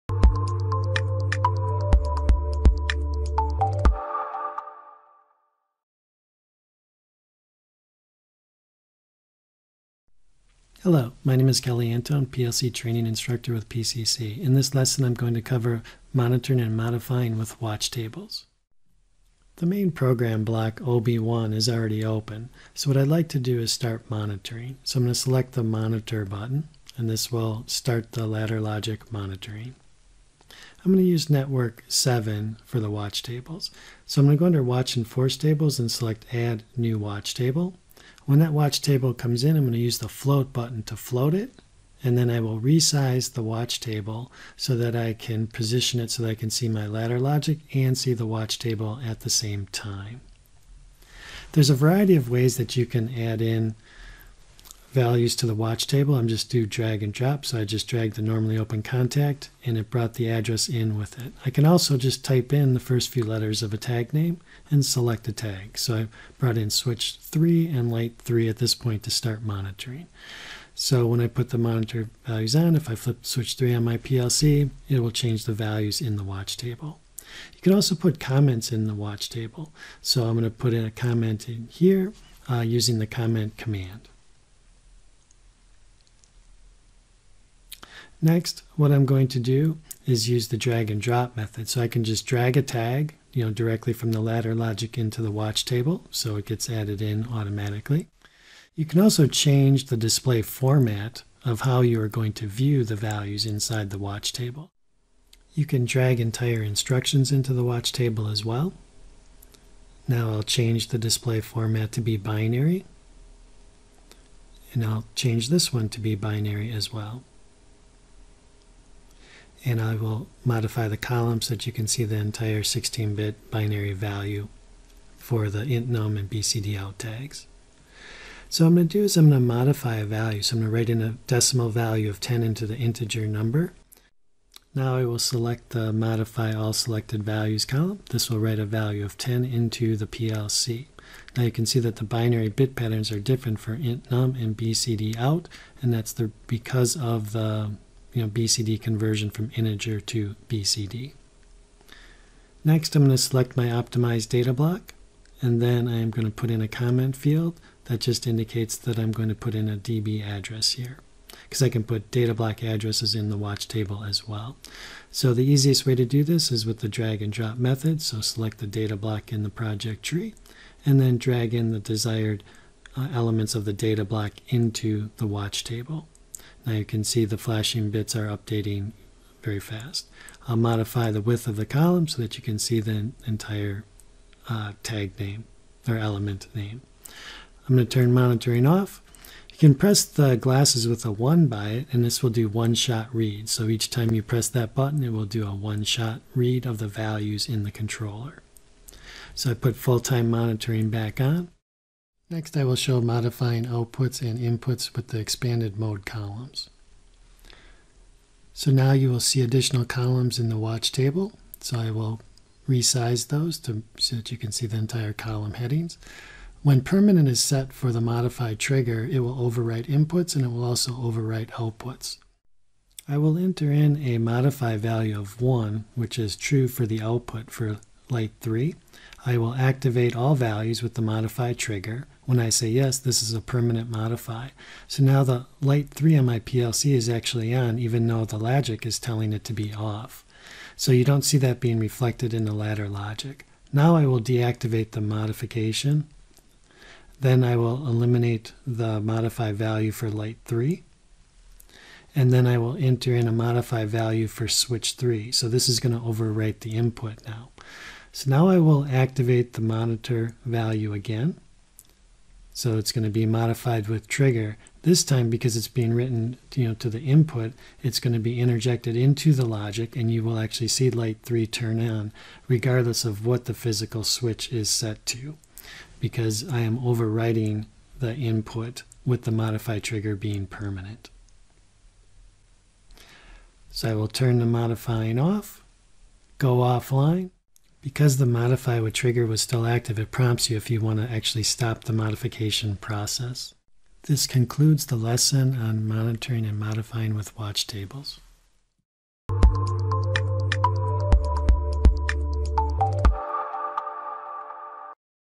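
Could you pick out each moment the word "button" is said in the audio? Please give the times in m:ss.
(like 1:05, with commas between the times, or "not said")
0:26, 0:40, 3:14.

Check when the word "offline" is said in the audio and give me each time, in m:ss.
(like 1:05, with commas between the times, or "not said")
4:46.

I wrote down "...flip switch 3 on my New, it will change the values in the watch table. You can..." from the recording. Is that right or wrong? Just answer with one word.
wrong.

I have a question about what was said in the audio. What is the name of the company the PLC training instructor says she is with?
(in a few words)
PCC.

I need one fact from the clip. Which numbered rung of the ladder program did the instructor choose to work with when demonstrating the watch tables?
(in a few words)
Network 7.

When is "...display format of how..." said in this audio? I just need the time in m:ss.
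1:39.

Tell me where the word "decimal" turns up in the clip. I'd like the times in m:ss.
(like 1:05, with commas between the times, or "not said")
2:11.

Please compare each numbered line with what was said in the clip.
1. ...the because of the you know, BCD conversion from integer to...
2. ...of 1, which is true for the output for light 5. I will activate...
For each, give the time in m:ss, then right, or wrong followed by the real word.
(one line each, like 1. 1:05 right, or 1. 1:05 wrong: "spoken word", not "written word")
1. 2:26 right
2. 3:45 wrong: "3", not "5".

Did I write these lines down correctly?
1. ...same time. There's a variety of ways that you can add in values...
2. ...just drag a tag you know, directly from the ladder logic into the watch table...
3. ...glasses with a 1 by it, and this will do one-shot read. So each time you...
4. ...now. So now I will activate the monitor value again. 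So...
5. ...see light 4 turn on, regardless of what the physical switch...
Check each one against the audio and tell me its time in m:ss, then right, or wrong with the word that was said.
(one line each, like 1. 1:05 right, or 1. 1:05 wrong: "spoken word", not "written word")
1. 0:49 right
2. 1:32 right
3. 3:10 right
4. 4:17 right
5. 4:30 wrong: "3", not "4".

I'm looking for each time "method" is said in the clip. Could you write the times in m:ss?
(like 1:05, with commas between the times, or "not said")
1:31, 2:47.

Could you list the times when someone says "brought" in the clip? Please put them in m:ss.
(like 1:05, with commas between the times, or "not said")
0:59, 1:06.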